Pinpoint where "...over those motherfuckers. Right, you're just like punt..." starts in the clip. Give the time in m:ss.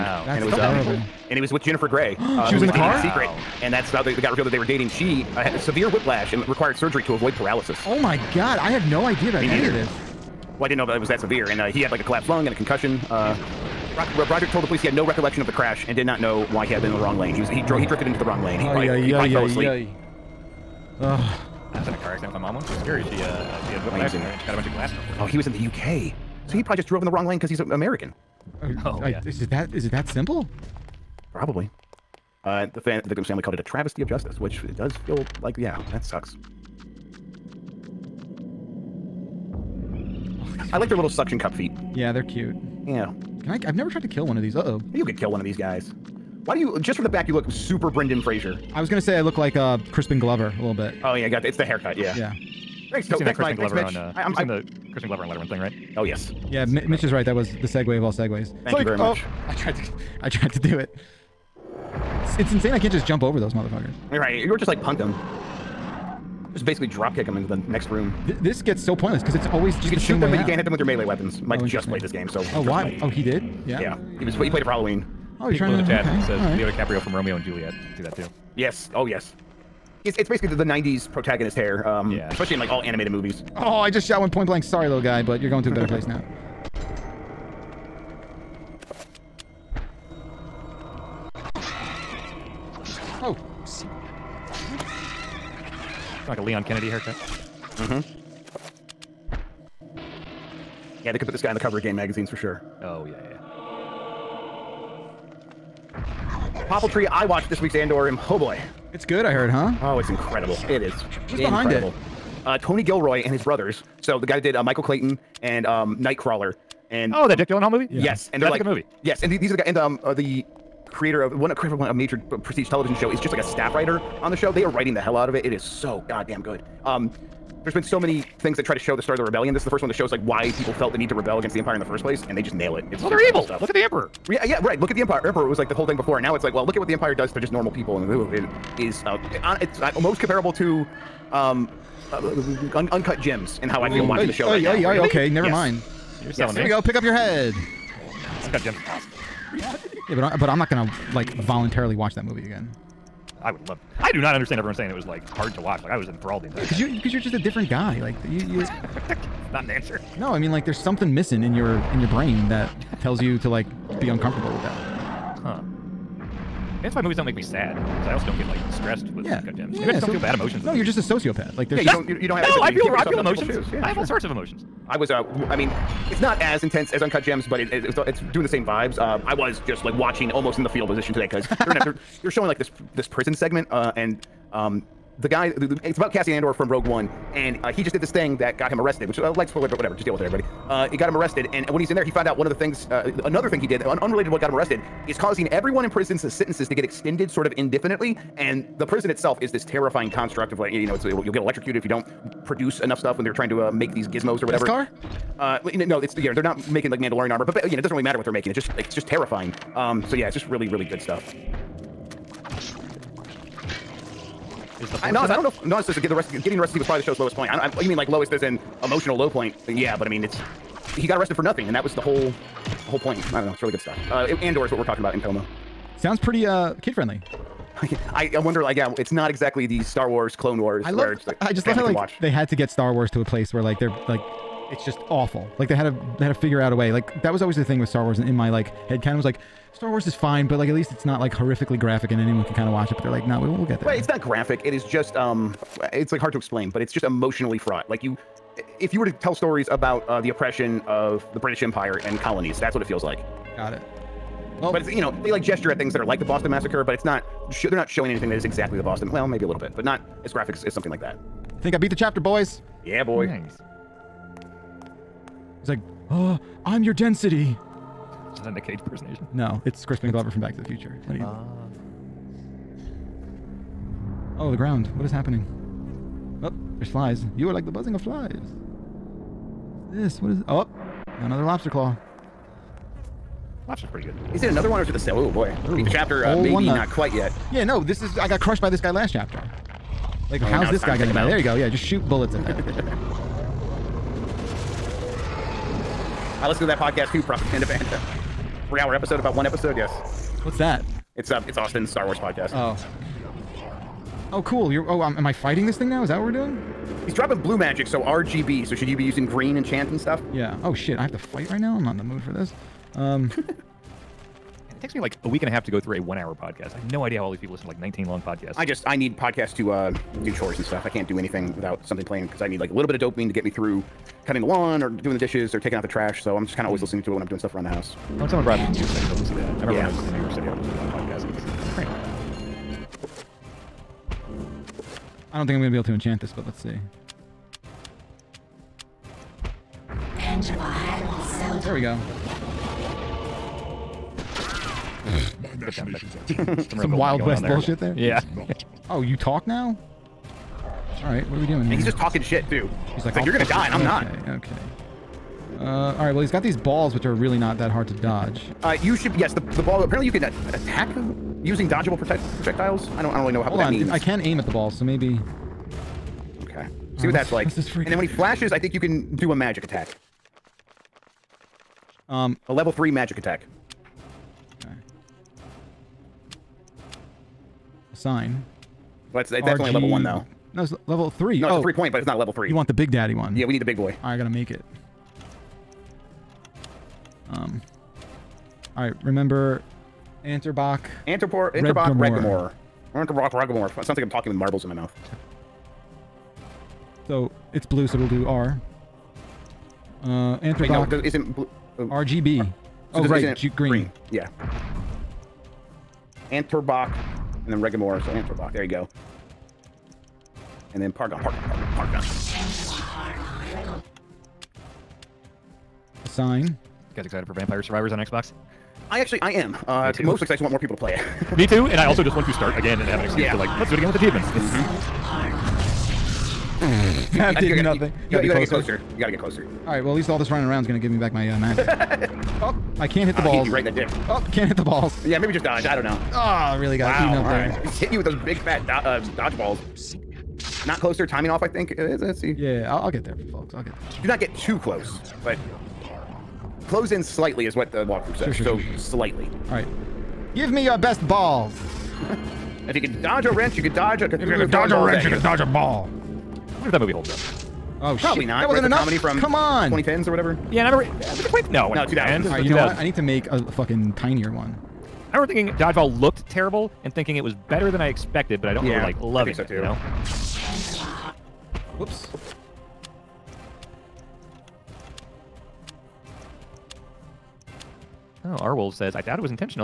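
1:03.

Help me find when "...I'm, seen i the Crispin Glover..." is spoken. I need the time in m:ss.
0:54.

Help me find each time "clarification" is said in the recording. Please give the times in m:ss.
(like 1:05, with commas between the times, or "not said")
not said.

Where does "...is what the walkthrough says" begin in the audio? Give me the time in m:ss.
7:27.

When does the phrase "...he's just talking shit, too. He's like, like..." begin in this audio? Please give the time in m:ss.
5:51.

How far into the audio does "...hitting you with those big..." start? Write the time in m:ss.
7:17.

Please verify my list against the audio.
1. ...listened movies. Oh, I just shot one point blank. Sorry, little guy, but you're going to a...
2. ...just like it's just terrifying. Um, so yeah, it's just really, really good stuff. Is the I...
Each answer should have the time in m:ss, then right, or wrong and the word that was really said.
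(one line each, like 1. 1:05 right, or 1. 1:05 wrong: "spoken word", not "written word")
1. 1:22 wrong: "animated", not "listened"
2. 3:28 right.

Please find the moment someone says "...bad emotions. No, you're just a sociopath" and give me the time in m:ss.
2:50.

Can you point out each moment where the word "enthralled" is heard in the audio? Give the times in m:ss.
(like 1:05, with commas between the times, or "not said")
2:36.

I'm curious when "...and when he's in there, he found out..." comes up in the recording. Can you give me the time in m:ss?
3:11.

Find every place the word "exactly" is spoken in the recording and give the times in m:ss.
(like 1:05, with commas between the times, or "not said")
3:49, 4:18.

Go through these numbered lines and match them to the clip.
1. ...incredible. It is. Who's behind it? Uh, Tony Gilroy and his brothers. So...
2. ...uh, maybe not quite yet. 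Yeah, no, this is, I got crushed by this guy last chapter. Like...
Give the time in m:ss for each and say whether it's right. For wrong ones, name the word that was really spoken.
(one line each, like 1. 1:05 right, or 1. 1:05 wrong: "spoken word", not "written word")
1. 1:50 right
2. 4:46 right.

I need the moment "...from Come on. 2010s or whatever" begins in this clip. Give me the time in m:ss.
7:38.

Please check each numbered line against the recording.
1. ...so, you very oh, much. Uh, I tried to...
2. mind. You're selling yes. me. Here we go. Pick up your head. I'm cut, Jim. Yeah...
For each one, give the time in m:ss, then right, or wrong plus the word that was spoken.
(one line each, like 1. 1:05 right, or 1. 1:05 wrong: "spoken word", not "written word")
1. 0:58 right
2. 2:25 right.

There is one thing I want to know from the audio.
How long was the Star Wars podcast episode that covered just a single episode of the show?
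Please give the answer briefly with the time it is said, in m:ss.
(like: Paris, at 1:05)
3 hours, at 4:58.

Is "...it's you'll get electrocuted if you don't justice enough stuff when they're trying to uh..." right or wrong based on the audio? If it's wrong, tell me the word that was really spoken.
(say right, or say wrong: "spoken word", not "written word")
wrong: "produce", not "justice".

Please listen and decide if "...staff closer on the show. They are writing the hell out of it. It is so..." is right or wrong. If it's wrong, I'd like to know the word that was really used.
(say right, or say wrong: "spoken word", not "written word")
wrong: "writer", not "closer".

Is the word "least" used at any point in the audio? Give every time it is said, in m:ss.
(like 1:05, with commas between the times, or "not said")
4:00, 7:09.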